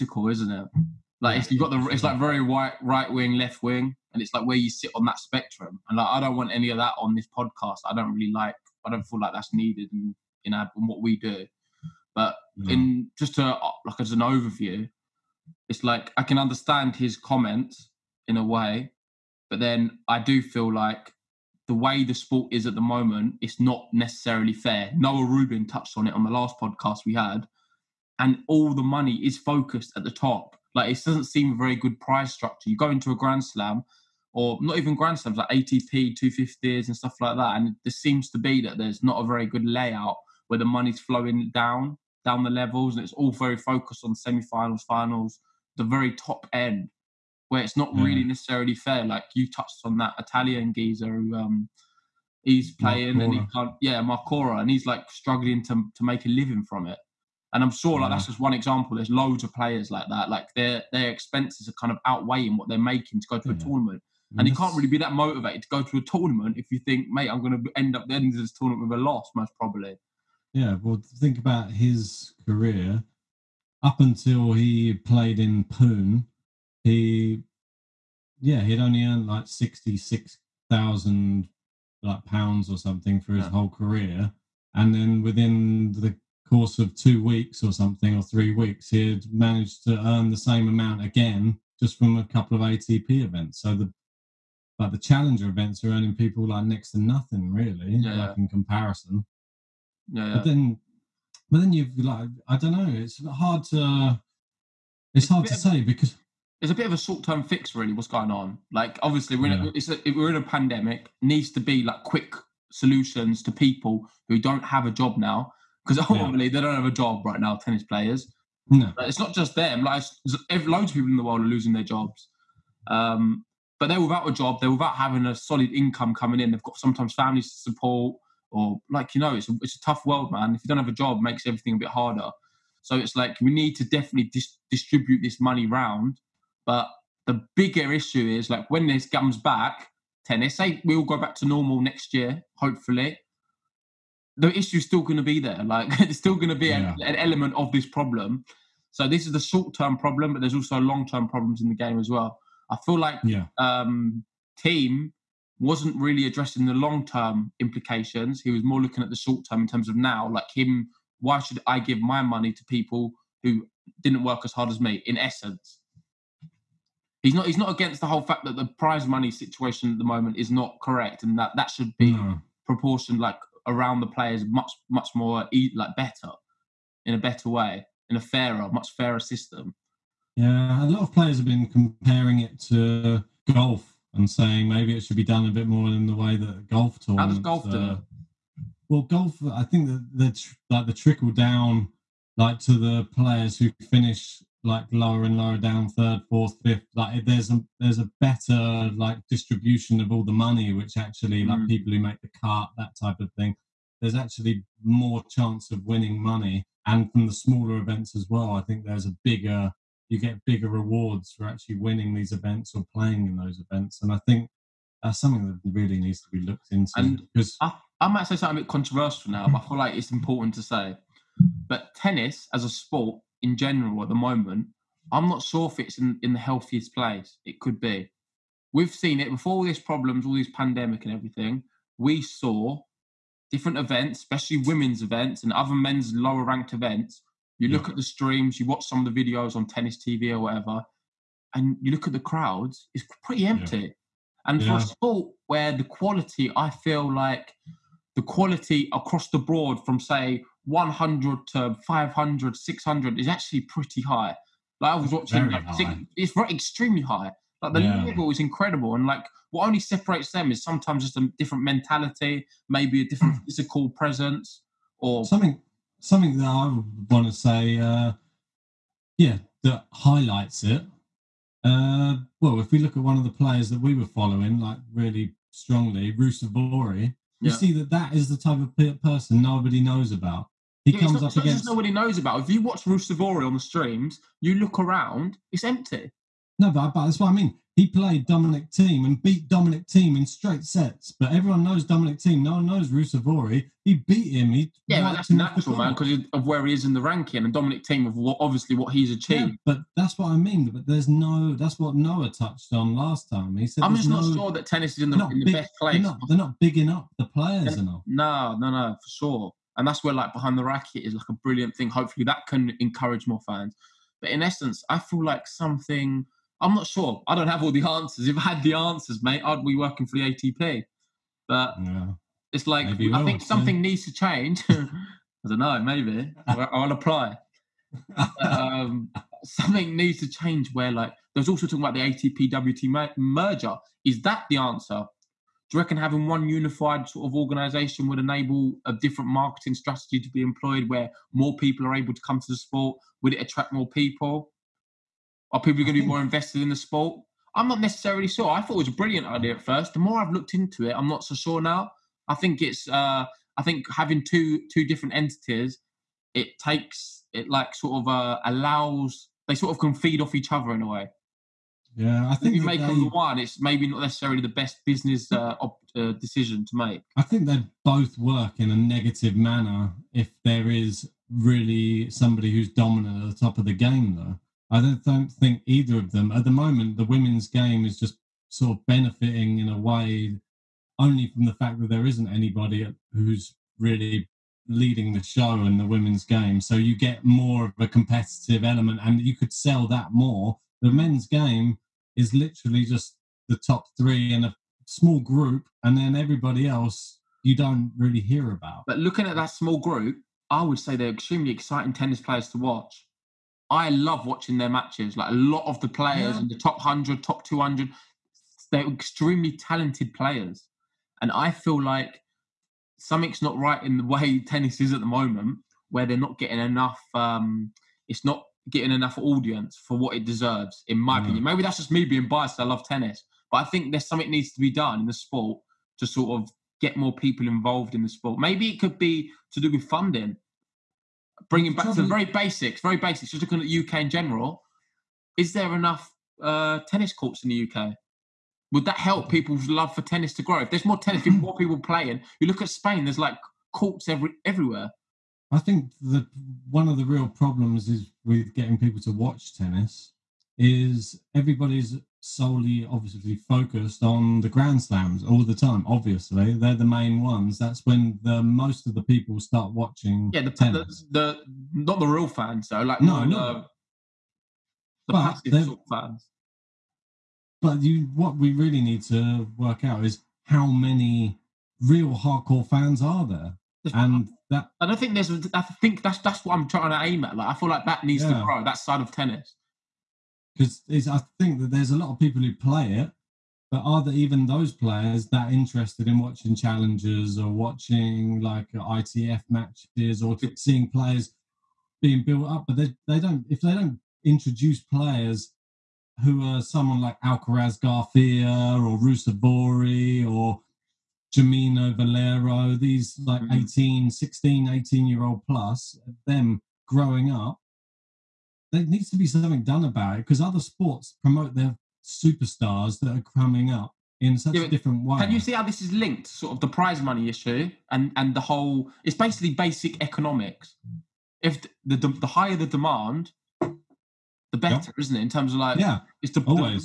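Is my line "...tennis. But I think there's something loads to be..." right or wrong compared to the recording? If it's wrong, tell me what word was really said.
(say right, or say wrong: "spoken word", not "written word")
wrong: "needs", not "loads".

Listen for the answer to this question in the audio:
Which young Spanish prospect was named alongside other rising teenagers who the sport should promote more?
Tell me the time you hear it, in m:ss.
8:17.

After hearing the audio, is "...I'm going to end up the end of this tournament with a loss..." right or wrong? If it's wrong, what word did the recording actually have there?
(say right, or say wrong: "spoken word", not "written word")
right.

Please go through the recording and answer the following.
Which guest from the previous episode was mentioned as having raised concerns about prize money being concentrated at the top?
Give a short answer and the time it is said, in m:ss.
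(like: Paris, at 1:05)
Noah Rubin, at 0:24.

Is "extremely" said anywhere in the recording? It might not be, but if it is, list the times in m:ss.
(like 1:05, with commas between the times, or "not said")
4:16, 6:41, 6:48.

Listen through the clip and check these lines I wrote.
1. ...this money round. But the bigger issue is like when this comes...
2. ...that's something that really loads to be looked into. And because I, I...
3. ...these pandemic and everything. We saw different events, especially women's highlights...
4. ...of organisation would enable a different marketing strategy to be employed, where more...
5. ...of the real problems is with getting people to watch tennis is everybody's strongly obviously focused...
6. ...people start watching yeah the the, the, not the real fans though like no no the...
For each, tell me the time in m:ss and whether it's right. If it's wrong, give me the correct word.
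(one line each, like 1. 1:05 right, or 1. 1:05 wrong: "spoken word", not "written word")
1. 2:15 right
2. 3:35 wrong: "needs", not "loads"
3. 3:50 wrong: "events", not "highlights"
4. 5:37 right
5. 7:26 wrong: "solely", not "strongly"
6. 7:39 right.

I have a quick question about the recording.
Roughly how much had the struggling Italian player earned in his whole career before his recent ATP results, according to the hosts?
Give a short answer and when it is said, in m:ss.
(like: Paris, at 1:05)
66,000 pounds, at 1:19.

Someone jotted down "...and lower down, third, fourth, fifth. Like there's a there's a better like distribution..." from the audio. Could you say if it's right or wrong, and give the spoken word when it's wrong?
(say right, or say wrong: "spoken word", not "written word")
right.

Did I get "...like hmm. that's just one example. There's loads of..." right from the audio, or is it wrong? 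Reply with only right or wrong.
right.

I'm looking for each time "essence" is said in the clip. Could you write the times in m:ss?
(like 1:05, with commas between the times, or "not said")
2:45, 5:14.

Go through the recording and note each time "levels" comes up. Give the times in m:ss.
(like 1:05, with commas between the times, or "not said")
0:42, 4:18.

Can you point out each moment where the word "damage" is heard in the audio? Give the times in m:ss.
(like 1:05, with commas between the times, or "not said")
not said.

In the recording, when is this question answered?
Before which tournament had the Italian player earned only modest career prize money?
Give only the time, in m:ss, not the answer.
1:15.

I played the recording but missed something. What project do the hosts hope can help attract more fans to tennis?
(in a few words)
Behind the Racket.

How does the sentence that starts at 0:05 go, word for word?
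And like I don't want any of that on this podcast.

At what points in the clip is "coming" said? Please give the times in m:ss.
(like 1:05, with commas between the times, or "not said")
2:06, 8:33.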